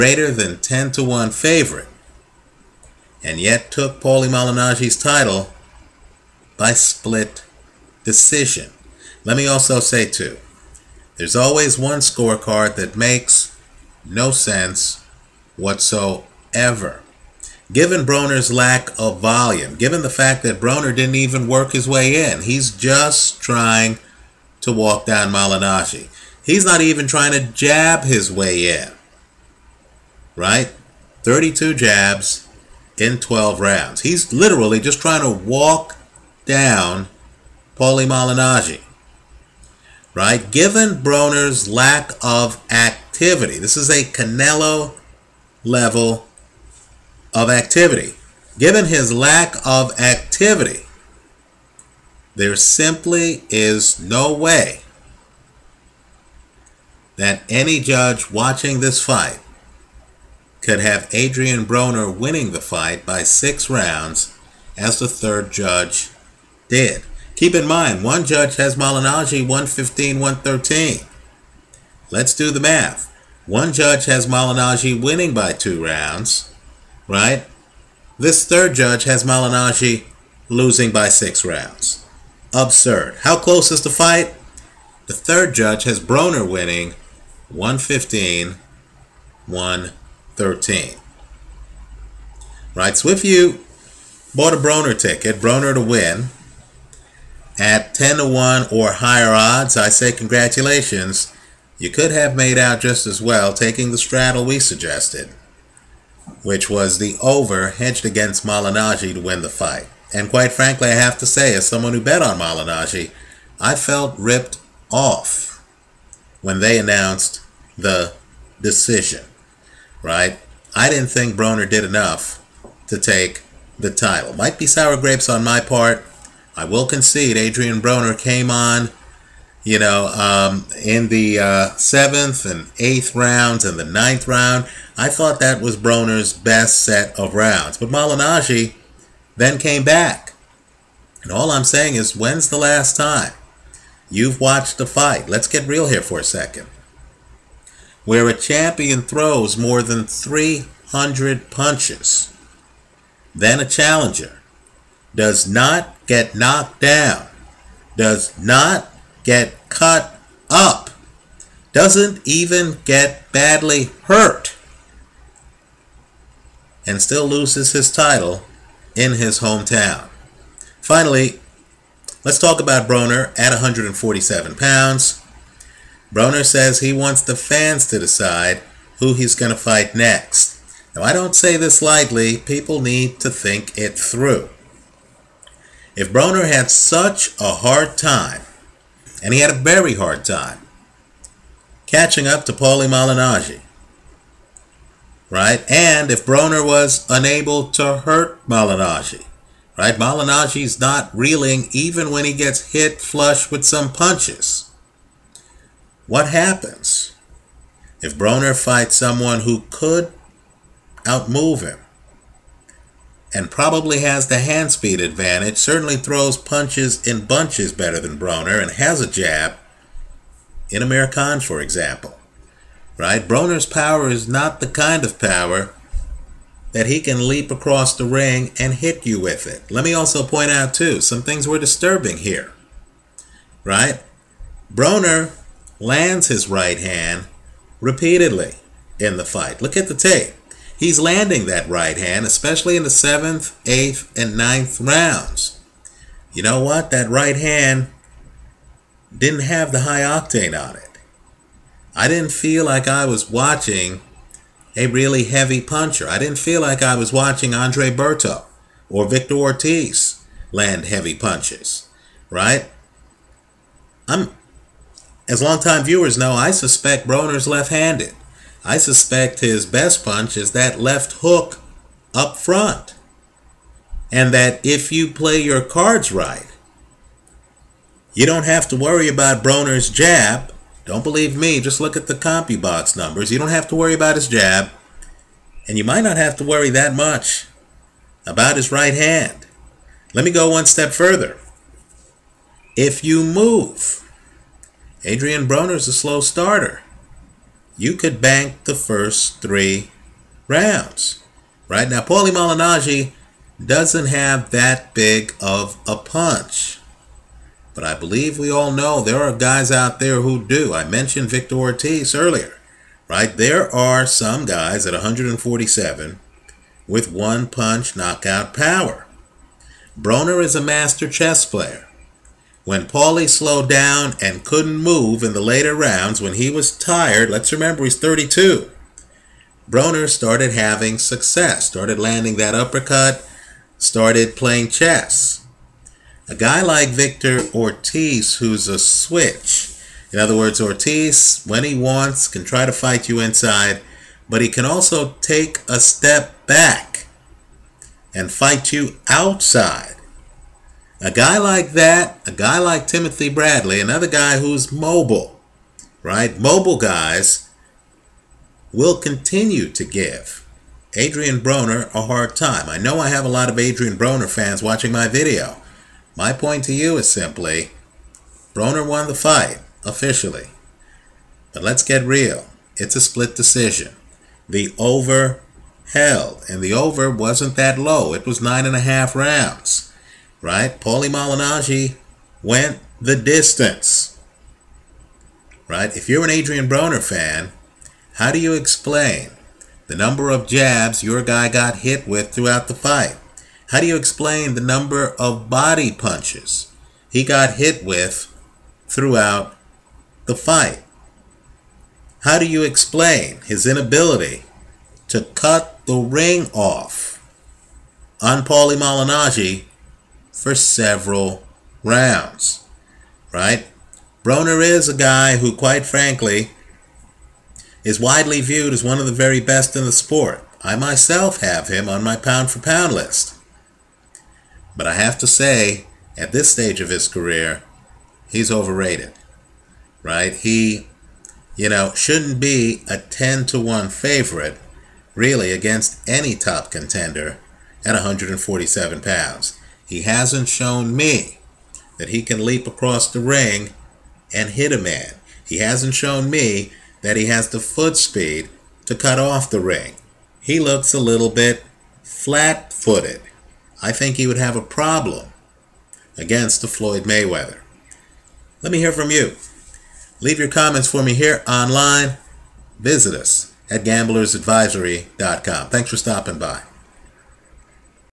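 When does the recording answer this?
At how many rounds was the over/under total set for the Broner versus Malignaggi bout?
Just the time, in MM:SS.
06:18.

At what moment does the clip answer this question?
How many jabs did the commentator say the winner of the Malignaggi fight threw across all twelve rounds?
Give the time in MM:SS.
00:31.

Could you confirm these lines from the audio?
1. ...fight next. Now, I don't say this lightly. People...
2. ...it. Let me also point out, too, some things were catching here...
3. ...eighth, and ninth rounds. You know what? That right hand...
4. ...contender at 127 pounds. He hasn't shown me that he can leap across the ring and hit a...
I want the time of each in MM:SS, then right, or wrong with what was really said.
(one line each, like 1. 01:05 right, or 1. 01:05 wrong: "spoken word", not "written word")
1. 02:59 right
2. 03:49 wrong: "disturbing", not "catching"
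3. 04:03 right
4. 07:16 wrong: "147", not "127".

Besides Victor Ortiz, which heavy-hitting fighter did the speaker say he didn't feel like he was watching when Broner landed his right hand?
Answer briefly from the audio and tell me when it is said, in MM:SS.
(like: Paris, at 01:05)
Andre Berto, at 04:17.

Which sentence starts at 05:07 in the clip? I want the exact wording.
But I believe we all know there are guys out there who do.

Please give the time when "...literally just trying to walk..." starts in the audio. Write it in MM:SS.
00:34.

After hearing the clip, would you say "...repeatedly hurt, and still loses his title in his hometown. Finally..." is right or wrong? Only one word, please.
wrong.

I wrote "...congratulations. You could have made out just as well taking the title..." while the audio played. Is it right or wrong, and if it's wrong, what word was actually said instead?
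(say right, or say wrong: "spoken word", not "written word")
wrong: "straddle", not "title".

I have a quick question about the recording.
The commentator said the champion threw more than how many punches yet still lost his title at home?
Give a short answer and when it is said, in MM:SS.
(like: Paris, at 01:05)
300, at 02:30.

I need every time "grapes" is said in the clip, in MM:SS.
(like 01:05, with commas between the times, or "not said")
02:04.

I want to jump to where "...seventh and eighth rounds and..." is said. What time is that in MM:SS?
02:11.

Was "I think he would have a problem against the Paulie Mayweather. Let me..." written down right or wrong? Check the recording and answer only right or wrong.
wrong.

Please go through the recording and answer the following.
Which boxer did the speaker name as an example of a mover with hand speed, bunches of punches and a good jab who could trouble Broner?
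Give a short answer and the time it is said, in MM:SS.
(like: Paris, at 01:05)
Amir Khan, at 03:40.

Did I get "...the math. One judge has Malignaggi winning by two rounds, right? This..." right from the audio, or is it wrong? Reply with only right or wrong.
right.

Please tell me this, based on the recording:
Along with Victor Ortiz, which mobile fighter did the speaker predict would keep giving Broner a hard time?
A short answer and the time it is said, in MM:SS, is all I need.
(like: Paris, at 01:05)
Timothy Bradley, at 05:52.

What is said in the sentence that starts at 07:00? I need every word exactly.
I myself have him on my pound for pound list.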